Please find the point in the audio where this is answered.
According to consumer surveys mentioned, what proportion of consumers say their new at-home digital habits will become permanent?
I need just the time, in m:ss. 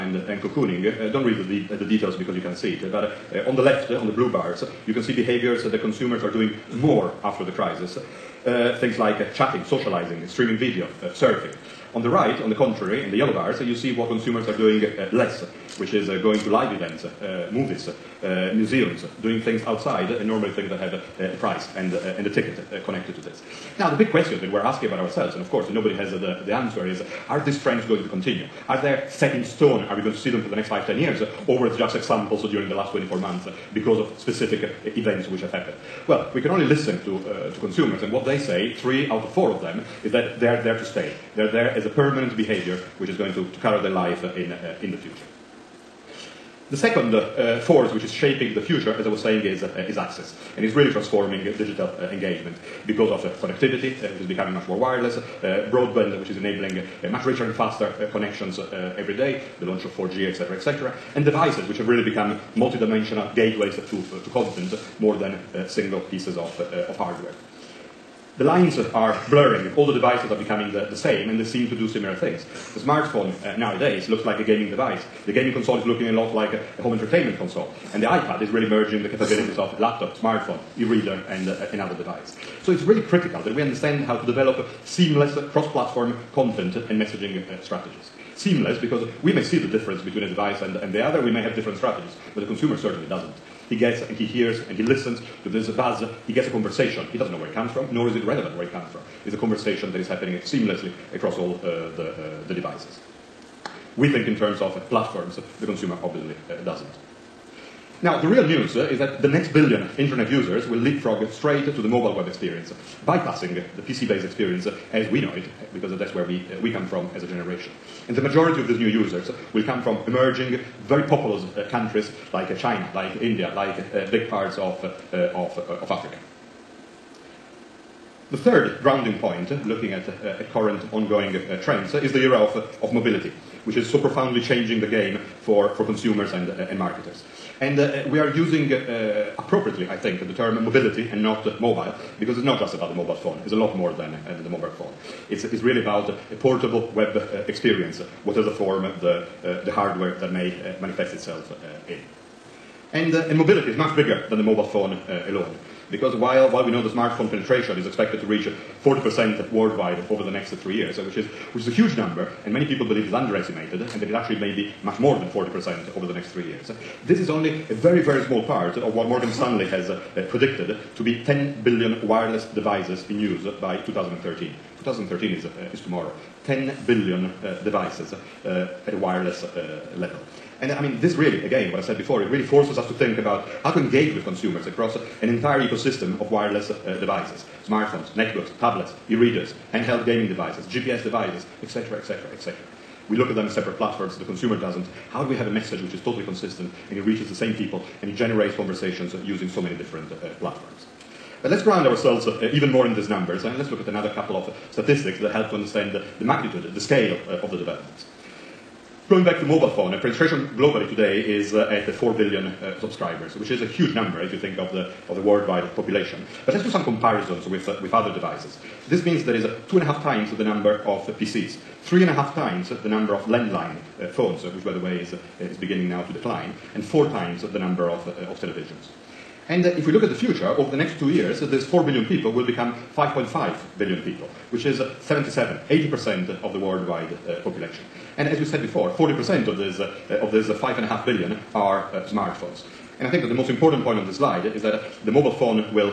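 0:38.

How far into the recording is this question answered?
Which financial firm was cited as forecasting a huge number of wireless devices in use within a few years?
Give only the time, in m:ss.
2:49.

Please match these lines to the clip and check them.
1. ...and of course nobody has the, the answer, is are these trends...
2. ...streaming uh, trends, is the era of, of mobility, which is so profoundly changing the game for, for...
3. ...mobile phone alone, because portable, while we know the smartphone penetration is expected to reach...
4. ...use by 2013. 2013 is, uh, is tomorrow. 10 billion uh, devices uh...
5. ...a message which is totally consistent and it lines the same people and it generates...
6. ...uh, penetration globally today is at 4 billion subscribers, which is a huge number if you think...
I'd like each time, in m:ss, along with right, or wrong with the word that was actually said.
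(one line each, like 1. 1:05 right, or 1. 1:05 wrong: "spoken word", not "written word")
1. 0:25 right
2. 2:10 wrong: "ongoing", not "streaming"
3. 2:34 wrong: "while", not "portable"
4. 2:53 right
5. 3:15 wrong: "reaches", not "lines"
6. 3:29 right.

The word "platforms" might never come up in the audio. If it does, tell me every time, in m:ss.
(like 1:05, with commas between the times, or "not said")
1:25, 1:44, 3:13, 3:20.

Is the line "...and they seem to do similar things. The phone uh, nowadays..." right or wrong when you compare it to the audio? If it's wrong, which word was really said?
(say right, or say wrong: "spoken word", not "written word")
wrong: "smartphone", not "phone".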